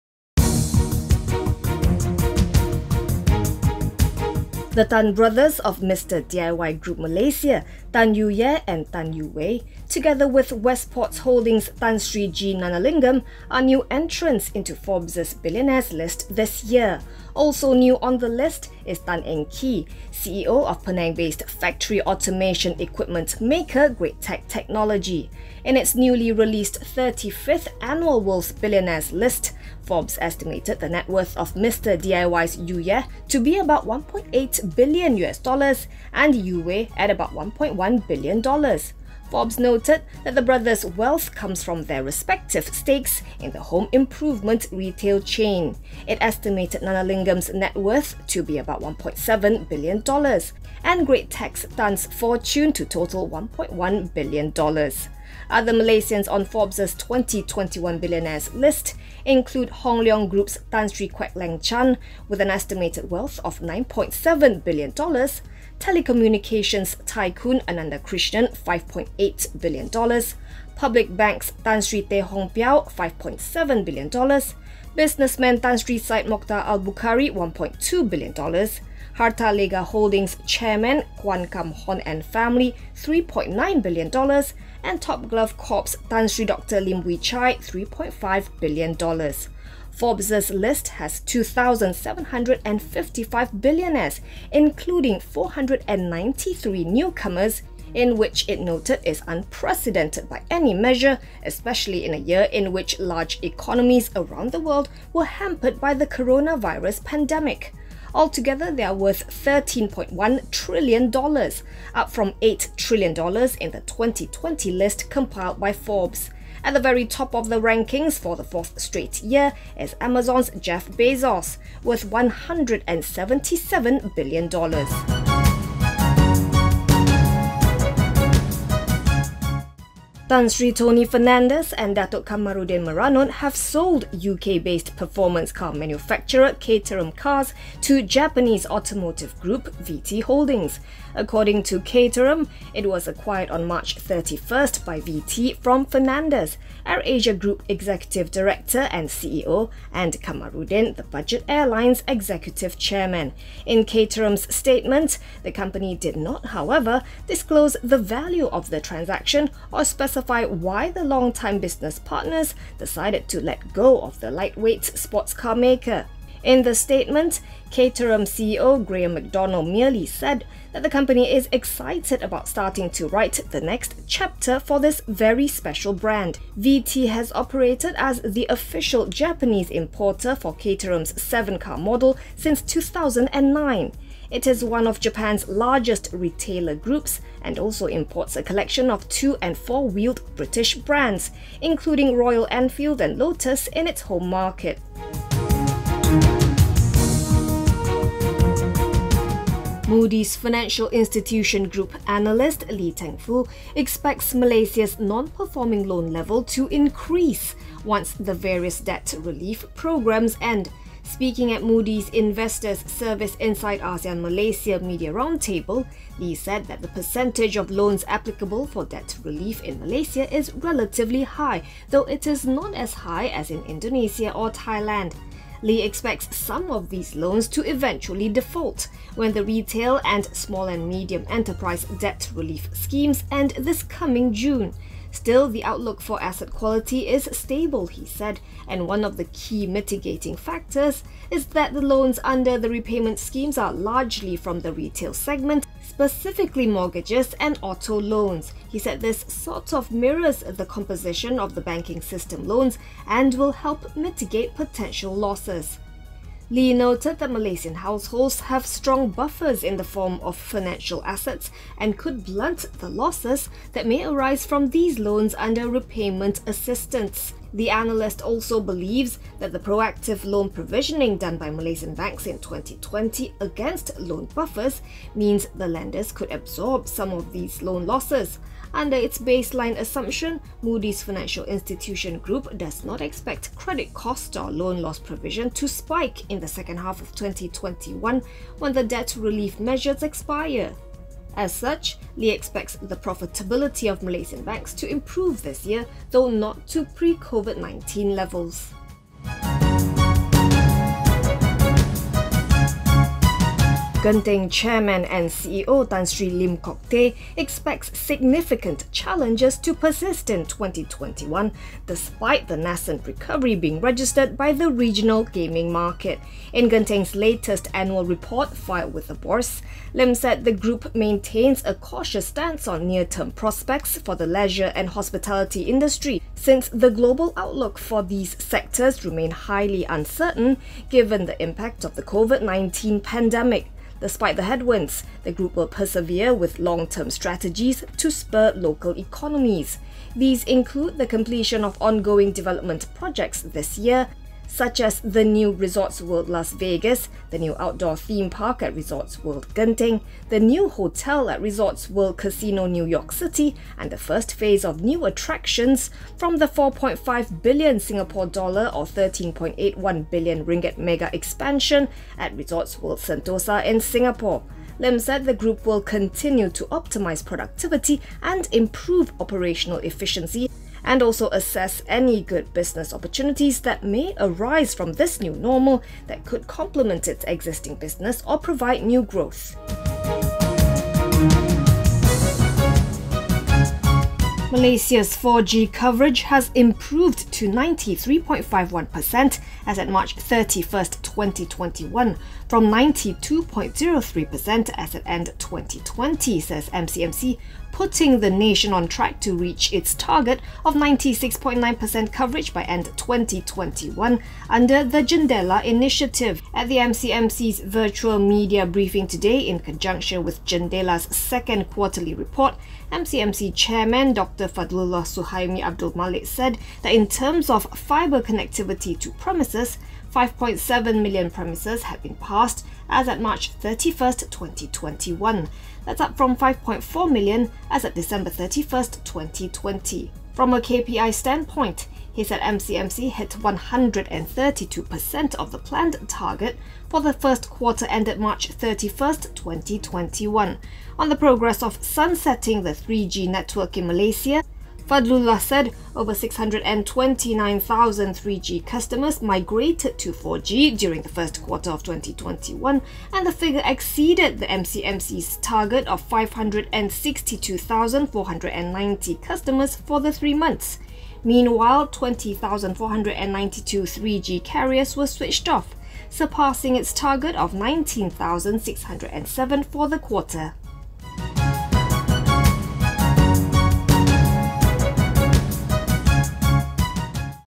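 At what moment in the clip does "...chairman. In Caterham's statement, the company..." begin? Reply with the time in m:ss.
2:32.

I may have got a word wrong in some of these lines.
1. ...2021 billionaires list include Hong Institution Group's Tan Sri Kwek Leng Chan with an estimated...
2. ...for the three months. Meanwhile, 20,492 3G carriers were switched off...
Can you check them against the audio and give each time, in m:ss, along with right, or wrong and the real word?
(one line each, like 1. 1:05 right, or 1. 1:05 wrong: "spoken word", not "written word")
1. 0:56 wrong: "Leong", not "Institution"
2. 7:39 right.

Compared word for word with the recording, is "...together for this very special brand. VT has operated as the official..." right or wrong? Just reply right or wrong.
wrong.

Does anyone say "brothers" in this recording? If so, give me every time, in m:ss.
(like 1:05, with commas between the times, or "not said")
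0:05, 0:40.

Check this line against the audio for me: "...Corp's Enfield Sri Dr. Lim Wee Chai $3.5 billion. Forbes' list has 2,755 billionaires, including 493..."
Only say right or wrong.
wrong.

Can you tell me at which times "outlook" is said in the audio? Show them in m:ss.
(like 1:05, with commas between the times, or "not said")
3:55, 5:27.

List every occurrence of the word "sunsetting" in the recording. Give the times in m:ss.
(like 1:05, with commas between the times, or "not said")
7:21.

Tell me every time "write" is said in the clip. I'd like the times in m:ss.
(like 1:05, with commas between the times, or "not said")
2:53.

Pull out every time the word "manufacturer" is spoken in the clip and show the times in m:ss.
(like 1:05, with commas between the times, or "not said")
2:15.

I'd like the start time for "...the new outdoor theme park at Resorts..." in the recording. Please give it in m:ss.
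5:47.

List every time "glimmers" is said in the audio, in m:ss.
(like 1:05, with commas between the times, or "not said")
not said.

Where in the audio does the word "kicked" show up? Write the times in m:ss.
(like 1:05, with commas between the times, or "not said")
not said.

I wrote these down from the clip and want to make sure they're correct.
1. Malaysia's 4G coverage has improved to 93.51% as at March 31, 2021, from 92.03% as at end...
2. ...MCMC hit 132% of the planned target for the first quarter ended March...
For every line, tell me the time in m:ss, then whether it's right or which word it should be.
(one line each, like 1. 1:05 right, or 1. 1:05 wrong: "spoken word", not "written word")
1. 6:24 right
2. 7:12 right.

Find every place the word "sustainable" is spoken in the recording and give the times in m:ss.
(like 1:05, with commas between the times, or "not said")
not said.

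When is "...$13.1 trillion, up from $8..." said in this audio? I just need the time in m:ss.
1:49.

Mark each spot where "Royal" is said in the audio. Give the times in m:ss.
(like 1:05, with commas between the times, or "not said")
3:12.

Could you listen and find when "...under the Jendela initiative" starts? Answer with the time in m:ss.
6:44.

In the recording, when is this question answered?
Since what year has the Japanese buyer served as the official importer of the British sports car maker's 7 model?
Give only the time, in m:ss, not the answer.
3:02.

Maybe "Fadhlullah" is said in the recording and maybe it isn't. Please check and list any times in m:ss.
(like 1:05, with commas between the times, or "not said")
6:54, 7:24.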